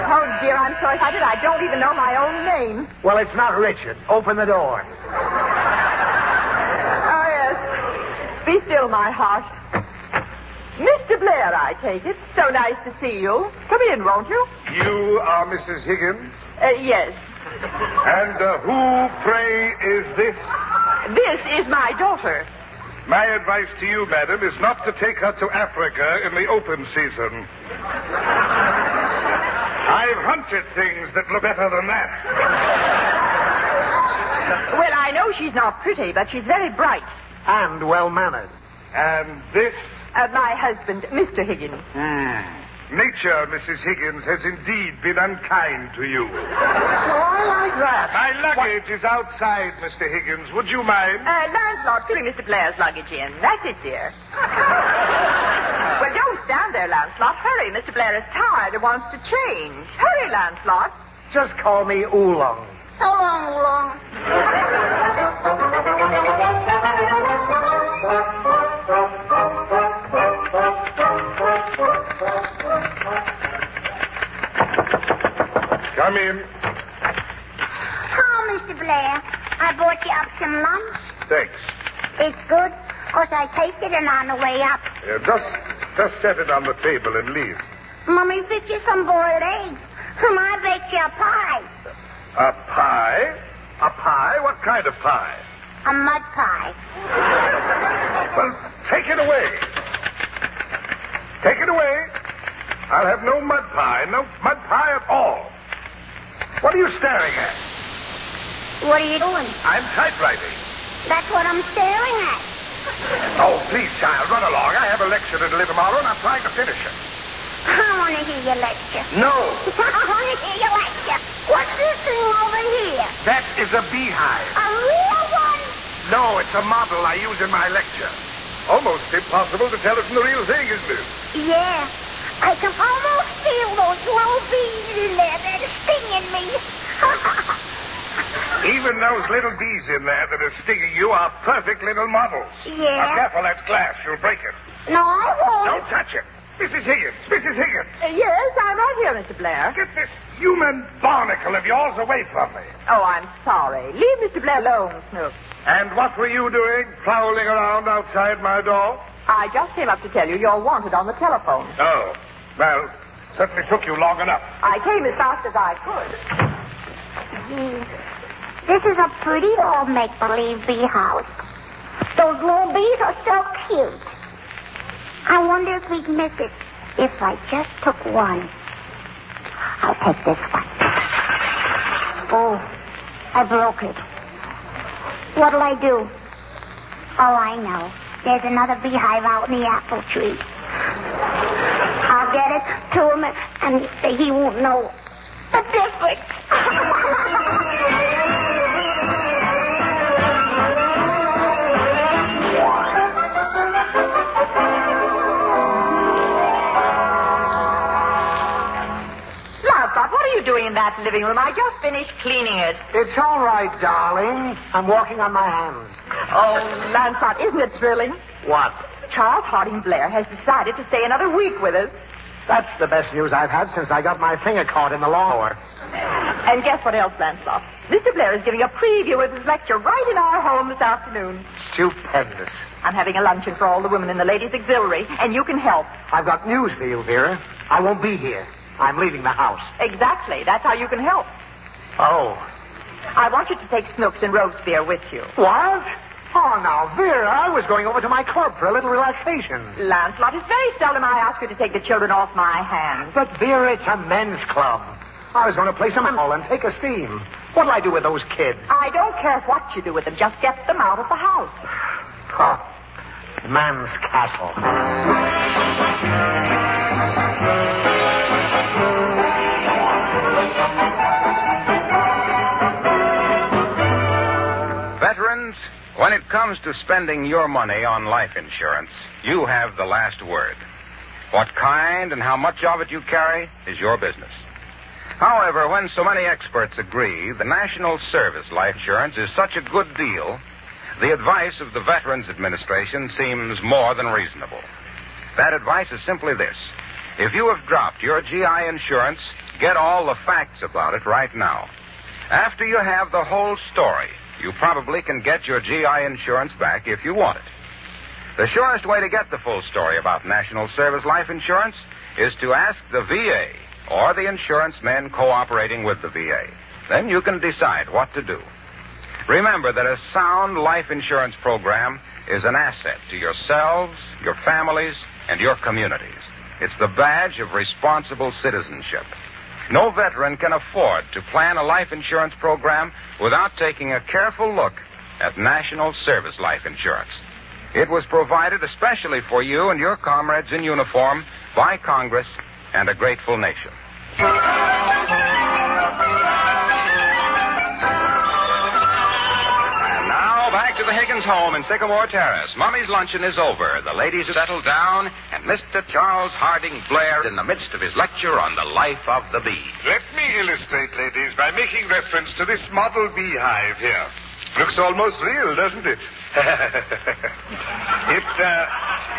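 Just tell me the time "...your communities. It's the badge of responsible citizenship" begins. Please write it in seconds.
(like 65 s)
325 s.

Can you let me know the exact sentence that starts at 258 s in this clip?
I don't care what you do with them.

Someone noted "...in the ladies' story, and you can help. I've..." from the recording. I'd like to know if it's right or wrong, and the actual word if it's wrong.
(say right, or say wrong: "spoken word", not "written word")
wrong: "auxiliary", not "story".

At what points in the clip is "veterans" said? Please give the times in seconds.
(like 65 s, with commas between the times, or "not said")
291 s, 329 s.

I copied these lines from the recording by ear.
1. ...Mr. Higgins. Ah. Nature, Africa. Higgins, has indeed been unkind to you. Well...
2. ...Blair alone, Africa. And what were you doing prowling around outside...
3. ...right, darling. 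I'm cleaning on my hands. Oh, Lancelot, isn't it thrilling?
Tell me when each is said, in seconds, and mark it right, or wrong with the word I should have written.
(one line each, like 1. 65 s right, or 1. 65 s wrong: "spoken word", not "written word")
1. 41 s wrong: "Mrs", not "Africa"
2. 154 s wrong: "Snoop", not "Africa"
3. 213 s wrong: "walking", not "cleaning".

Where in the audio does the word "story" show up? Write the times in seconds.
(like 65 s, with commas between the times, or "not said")
303 s, 309 s.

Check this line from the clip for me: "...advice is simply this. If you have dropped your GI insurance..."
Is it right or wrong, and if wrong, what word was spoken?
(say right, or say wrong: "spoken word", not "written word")
right.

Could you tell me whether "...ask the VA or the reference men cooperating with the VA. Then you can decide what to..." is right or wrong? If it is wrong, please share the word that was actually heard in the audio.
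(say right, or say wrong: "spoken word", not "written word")
wrong: "insurance", not "reference".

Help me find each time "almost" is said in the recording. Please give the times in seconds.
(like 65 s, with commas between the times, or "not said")
128 s, 132 s, 364 s.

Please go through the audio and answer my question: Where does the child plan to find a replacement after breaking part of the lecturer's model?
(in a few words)
The apple tree.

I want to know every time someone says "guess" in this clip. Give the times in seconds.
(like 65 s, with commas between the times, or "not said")
226 s.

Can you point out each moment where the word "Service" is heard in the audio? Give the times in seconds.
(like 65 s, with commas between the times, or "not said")
287 s, 310 s, 335 s.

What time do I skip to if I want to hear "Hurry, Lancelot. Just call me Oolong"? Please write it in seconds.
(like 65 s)
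59 s.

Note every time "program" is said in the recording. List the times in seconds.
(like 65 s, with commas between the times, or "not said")
321 s, 332 s.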